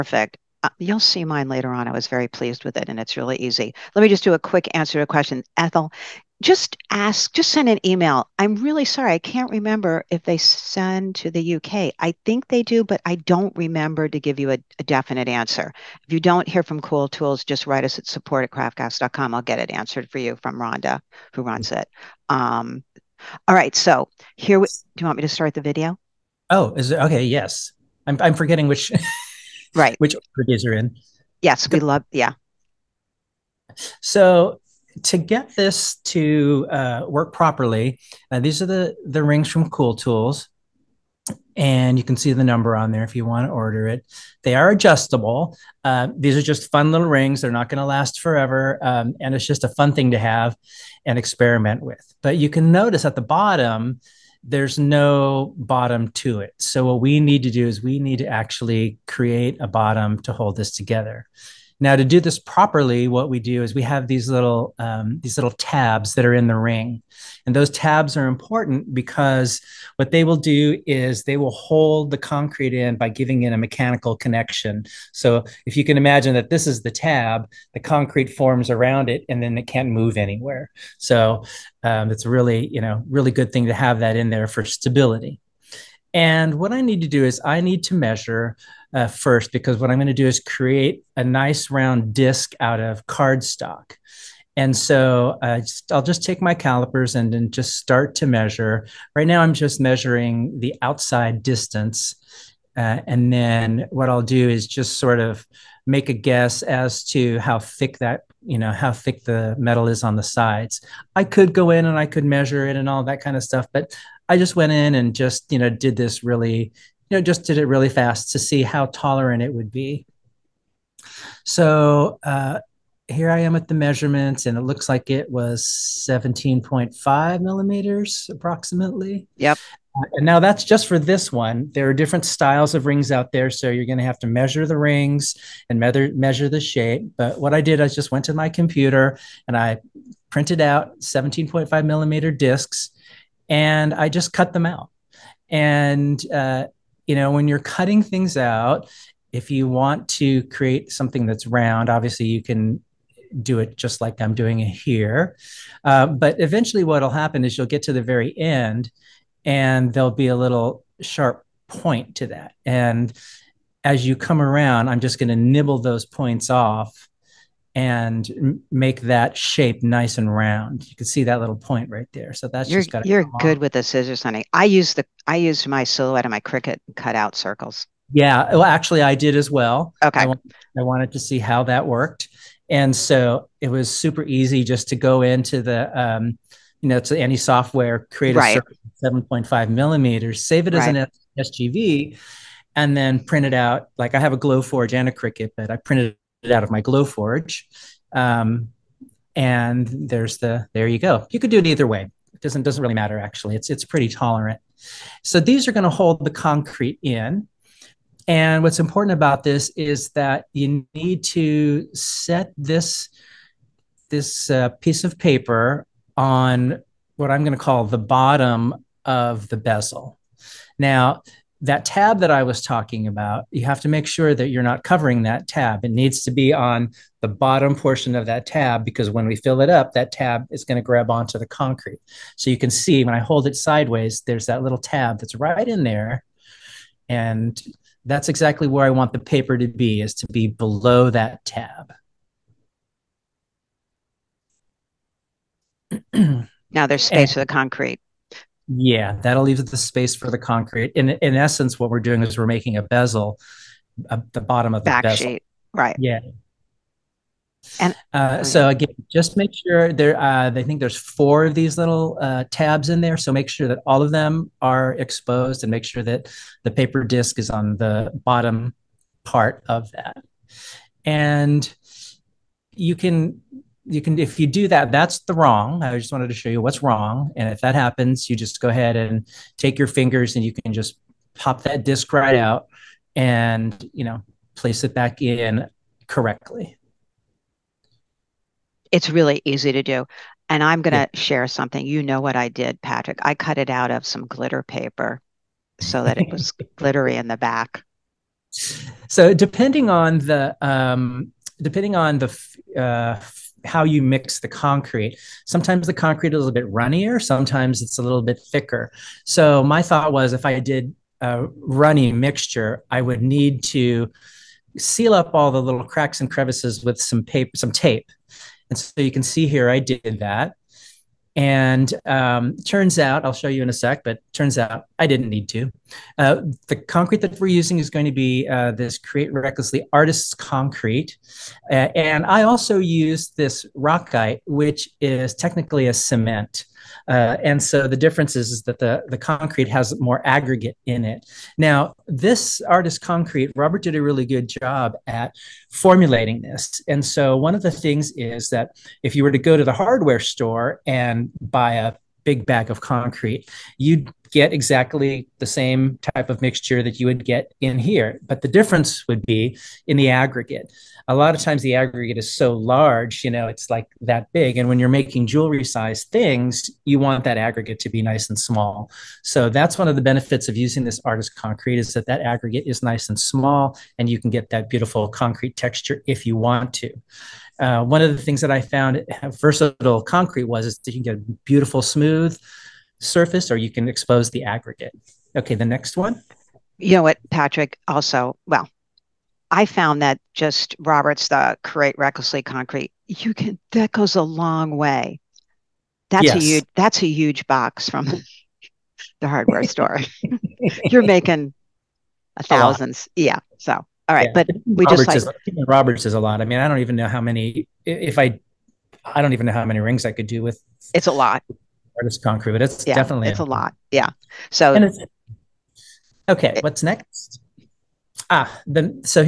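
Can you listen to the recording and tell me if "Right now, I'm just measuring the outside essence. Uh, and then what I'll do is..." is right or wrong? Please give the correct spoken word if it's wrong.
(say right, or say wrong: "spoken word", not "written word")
wrong: "distance", not "essence".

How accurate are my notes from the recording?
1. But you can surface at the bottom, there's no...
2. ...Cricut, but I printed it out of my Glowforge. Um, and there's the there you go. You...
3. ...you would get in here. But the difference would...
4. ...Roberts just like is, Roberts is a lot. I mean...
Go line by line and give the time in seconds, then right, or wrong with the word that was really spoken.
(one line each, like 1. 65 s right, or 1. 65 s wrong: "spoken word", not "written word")
1. 52 s wrong: "notice", not "surface"
2. 195 s right
3. 357 s right
4. 404 s right.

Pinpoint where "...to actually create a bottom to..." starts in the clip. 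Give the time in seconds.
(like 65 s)
58 s.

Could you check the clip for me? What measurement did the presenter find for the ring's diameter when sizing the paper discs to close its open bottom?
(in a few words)
17.5 millimeters.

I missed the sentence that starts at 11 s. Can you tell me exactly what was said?
I think they do, but I don't remember to give you a, a definite answer.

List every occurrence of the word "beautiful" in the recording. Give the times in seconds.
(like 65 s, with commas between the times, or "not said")
374 s, 381 s.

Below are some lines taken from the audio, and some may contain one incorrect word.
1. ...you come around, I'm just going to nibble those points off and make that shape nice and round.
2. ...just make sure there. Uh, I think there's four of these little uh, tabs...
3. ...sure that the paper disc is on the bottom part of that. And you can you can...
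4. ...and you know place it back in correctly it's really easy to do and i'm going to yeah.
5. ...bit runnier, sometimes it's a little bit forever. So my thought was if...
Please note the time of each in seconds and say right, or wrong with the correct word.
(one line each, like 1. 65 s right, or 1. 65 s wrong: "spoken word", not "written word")
1. 164 s right
2. 259 s right
3. 265 s right
4. 283 s right
5. 306 s wrong: "thicker", not "forever".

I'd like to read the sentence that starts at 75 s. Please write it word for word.
So, if you can imagine that this is the tab, the concrete forms around it, and then it can't move anywhere.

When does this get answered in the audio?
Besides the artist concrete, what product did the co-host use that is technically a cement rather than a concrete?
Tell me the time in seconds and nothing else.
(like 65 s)
333 s.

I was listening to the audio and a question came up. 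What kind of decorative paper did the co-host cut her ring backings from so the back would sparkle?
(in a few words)
glitter paper.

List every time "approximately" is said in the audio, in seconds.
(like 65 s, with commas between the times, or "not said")
128 s.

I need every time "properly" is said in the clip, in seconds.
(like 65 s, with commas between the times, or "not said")
37 s, 62 s.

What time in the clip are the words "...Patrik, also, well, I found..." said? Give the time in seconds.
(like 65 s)
387 s.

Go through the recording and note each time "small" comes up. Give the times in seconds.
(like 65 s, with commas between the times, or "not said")
368 s, 373 s.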